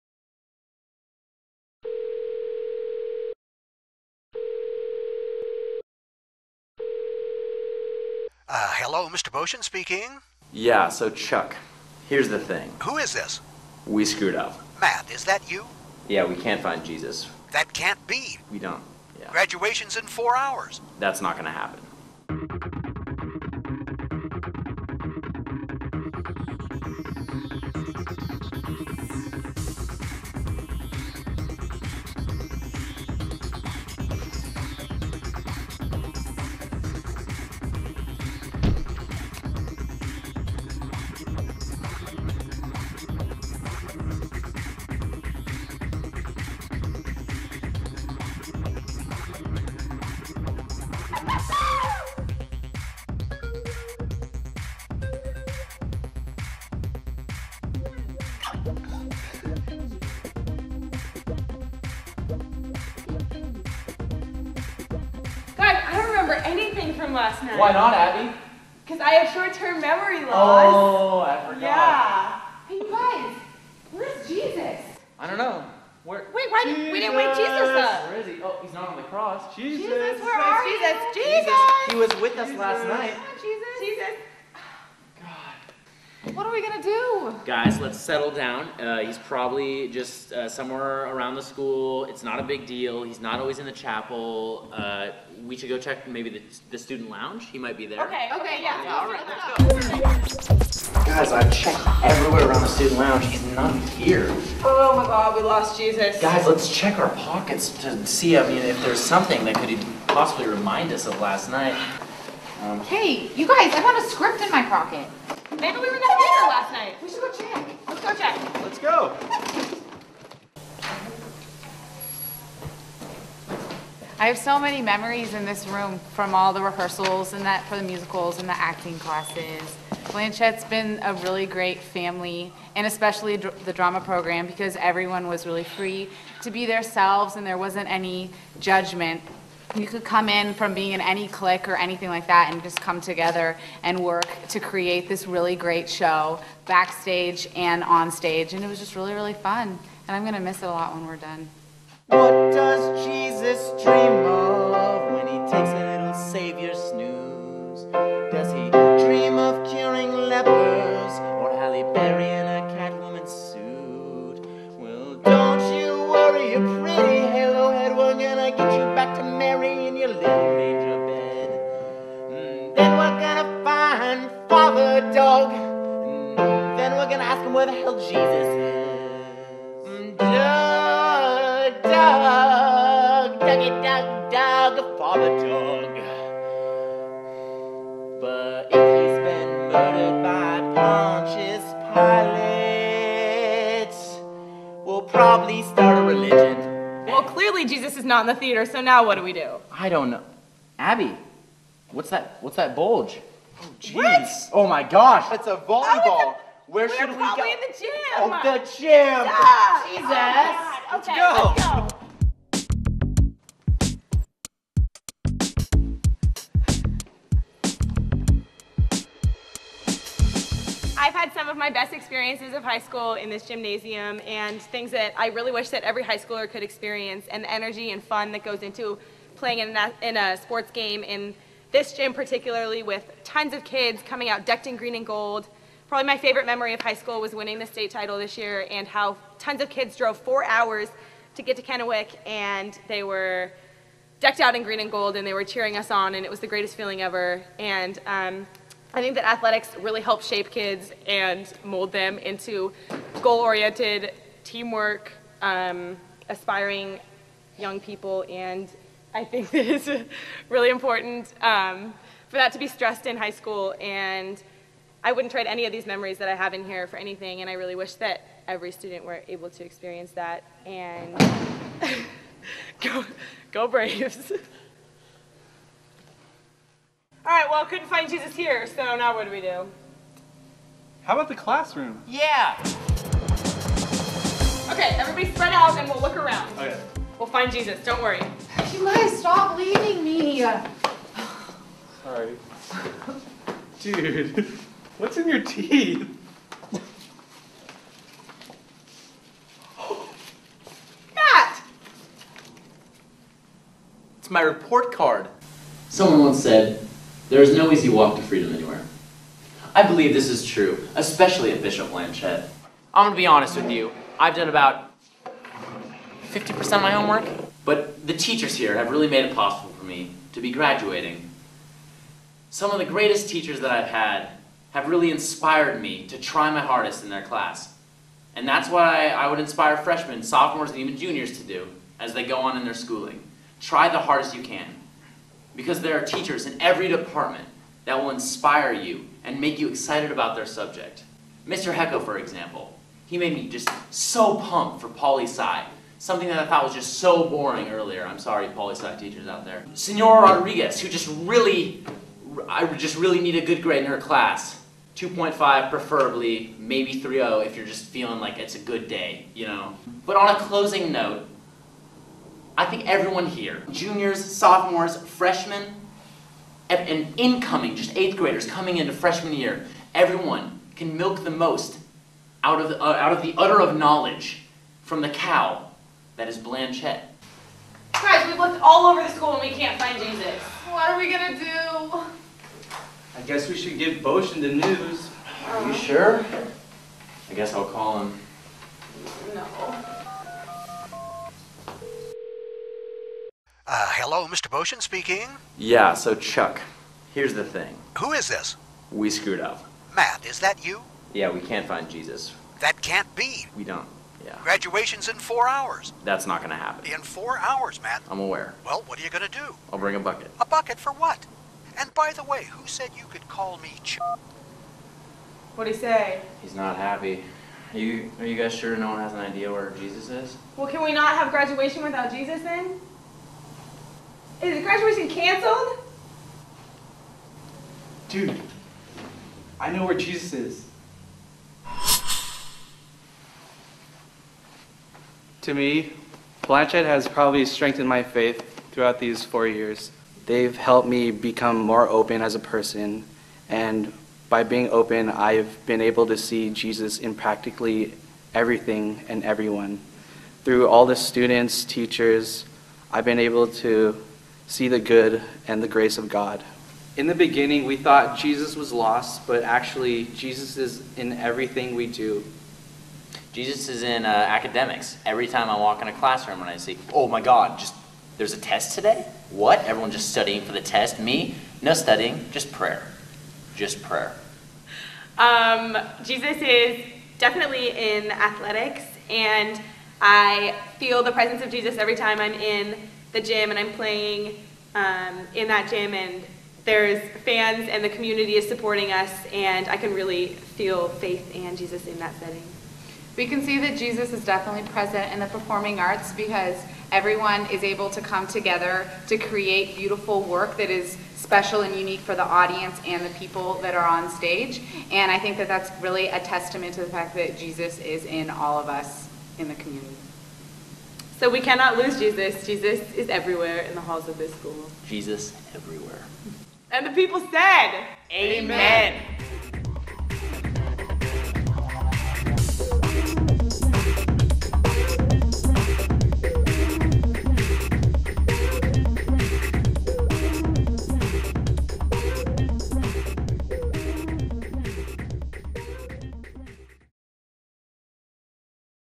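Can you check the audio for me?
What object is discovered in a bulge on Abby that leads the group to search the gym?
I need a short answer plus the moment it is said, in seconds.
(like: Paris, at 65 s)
A volleyball, at 205 s.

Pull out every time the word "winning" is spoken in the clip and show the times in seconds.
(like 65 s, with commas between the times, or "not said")
237 s.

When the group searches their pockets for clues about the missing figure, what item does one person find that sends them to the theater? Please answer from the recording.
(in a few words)
A script.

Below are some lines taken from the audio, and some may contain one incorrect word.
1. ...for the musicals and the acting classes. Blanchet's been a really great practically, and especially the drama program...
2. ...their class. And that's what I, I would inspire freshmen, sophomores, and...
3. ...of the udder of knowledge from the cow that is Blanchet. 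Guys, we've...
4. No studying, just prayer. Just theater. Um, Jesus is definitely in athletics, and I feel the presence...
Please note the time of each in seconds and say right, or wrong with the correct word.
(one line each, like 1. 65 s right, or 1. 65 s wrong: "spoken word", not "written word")
1. 127 s wrong: "family", not "practically"
2. 327 s right
3. 373 s right
4. 471 s wrong: "prayer", not "theater".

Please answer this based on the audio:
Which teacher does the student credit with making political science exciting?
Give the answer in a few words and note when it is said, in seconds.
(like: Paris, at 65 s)
Mr. Hecko, at 341 s.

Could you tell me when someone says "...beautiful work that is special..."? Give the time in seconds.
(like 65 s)
499 s.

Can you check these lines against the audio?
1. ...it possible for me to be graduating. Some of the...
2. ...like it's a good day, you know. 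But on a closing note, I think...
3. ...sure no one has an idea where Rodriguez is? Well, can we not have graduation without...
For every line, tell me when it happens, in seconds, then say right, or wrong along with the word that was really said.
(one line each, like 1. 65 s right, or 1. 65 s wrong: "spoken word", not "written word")
1. 319 s right
2. 358 s right
3. 418 s wrong: "Jesus", not "Rodriguez".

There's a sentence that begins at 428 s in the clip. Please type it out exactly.
Dude, I know where Jesus is.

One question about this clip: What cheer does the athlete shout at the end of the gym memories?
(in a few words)
Go Braves.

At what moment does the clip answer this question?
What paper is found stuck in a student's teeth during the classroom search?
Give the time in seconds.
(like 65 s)
304 s.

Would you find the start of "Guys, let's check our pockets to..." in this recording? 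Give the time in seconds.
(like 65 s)
106 s.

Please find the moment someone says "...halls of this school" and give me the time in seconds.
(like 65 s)
513 s.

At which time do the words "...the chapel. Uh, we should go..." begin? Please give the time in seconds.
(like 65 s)
93 s.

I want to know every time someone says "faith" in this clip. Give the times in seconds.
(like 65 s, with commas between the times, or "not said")
438 s, 490 s.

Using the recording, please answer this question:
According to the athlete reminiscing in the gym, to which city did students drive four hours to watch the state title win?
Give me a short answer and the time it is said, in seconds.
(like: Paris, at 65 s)
Kennewick, at 241 s.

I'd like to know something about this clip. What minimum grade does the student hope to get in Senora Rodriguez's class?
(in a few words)
2.5.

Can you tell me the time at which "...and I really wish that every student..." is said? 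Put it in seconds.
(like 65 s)
267 s.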